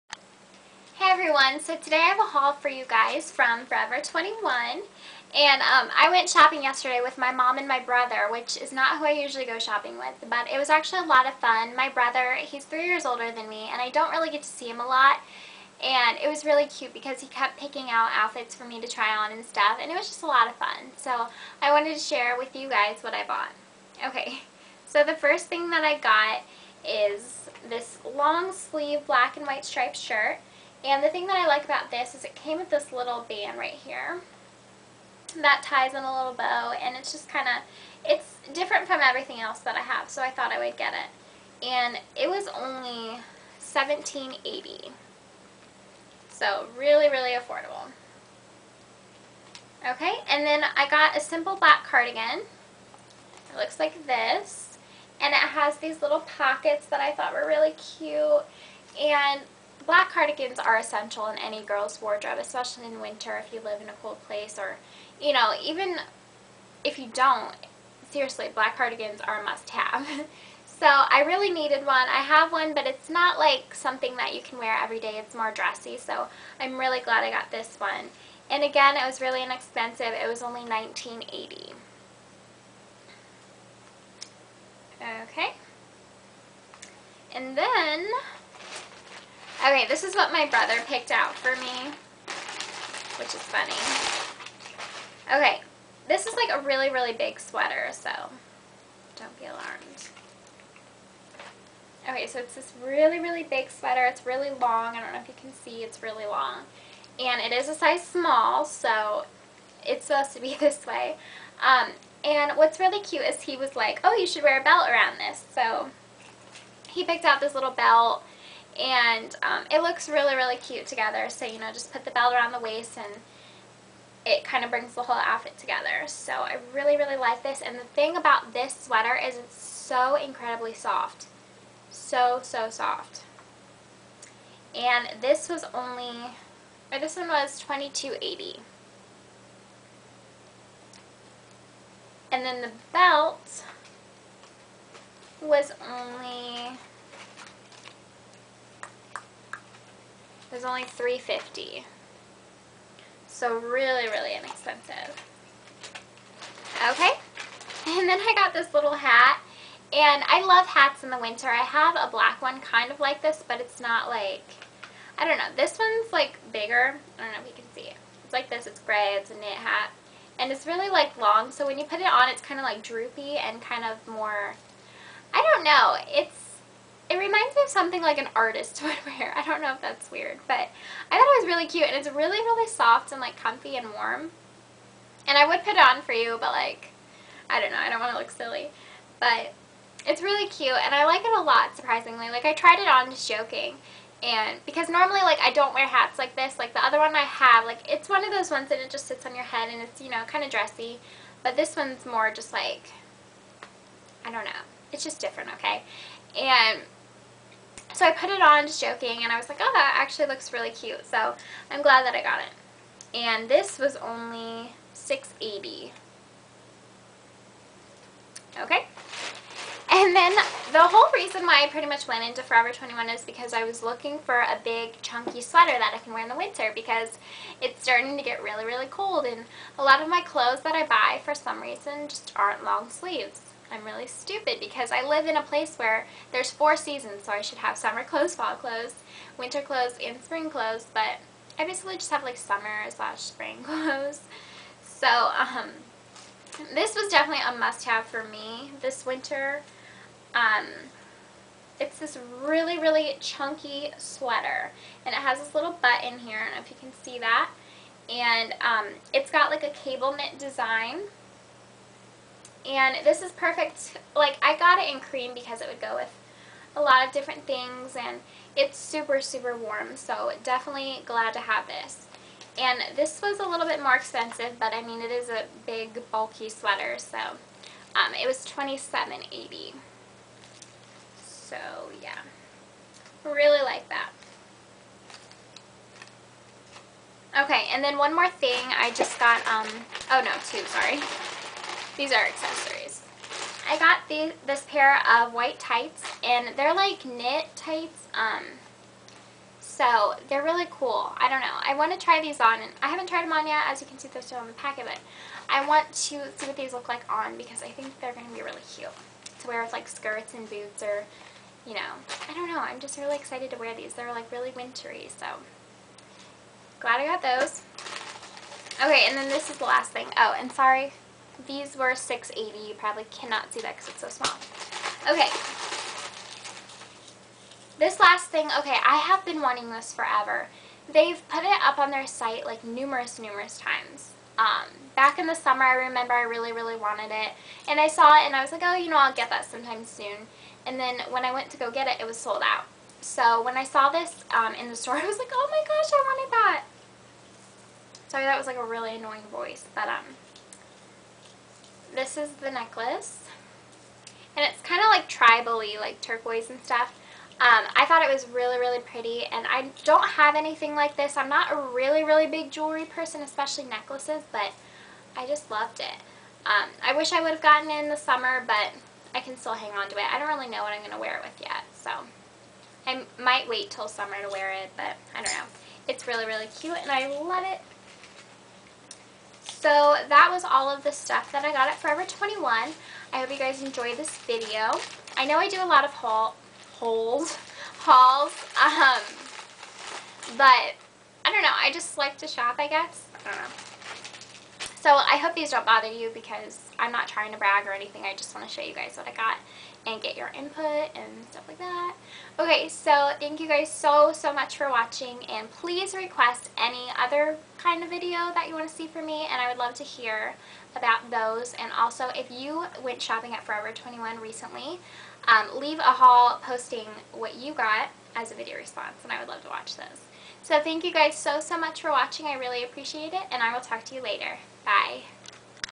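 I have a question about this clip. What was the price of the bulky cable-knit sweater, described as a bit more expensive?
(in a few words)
$27.80.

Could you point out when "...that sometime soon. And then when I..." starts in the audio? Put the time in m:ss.
5:39.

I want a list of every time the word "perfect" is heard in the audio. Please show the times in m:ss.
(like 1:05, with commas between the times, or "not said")
4:23.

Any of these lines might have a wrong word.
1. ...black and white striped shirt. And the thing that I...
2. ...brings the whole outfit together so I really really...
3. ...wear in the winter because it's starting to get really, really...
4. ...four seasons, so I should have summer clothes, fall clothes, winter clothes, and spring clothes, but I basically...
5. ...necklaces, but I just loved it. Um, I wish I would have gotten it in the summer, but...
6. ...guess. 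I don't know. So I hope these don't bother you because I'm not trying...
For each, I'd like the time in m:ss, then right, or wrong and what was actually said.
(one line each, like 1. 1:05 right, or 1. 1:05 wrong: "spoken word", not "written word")
1. 0:29 right
2. 2:04 right
3. 3:46 right
4. 3:56 right
5. 6:03 right
6. 6:32 right.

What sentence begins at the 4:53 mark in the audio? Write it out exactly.
I got the, this pair of white tights, and they're like knit tights, um, so they're really cool.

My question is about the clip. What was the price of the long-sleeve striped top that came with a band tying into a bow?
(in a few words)
$17.80.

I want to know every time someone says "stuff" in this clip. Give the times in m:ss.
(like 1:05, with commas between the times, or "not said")
0:19, 5:56, 6:20, 6:41.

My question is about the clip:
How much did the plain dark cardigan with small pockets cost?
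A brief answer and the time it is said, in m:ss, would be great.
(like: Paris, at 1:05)
$19.80, at 1:20.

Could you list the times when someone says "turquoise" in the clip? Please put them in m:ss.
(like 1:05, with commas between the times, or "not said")
5:56.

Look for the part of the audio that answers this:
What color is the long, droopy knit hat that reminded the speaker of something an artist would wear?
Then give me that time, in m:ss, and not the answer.
2:48.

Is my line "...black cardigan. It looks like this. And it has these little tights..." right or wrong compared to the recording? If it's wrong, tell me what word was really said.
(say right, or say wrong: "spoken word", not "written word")
wrong: "pockets", not "tights".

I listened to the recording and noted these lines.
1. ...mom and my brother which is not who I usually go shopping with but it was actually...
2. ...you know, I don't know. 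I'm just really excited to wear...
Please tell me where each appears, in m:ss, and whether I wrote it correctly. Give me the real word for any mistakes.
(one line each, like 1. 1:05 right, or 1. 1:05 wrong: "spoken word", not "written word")
1. 0:07 right
2. 5:11 right.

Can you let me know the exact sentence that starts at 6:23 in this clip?
I hope you guys enjoyed this video.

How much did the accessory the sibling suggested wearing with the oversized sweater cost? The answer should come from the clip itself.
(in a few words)
$3.50.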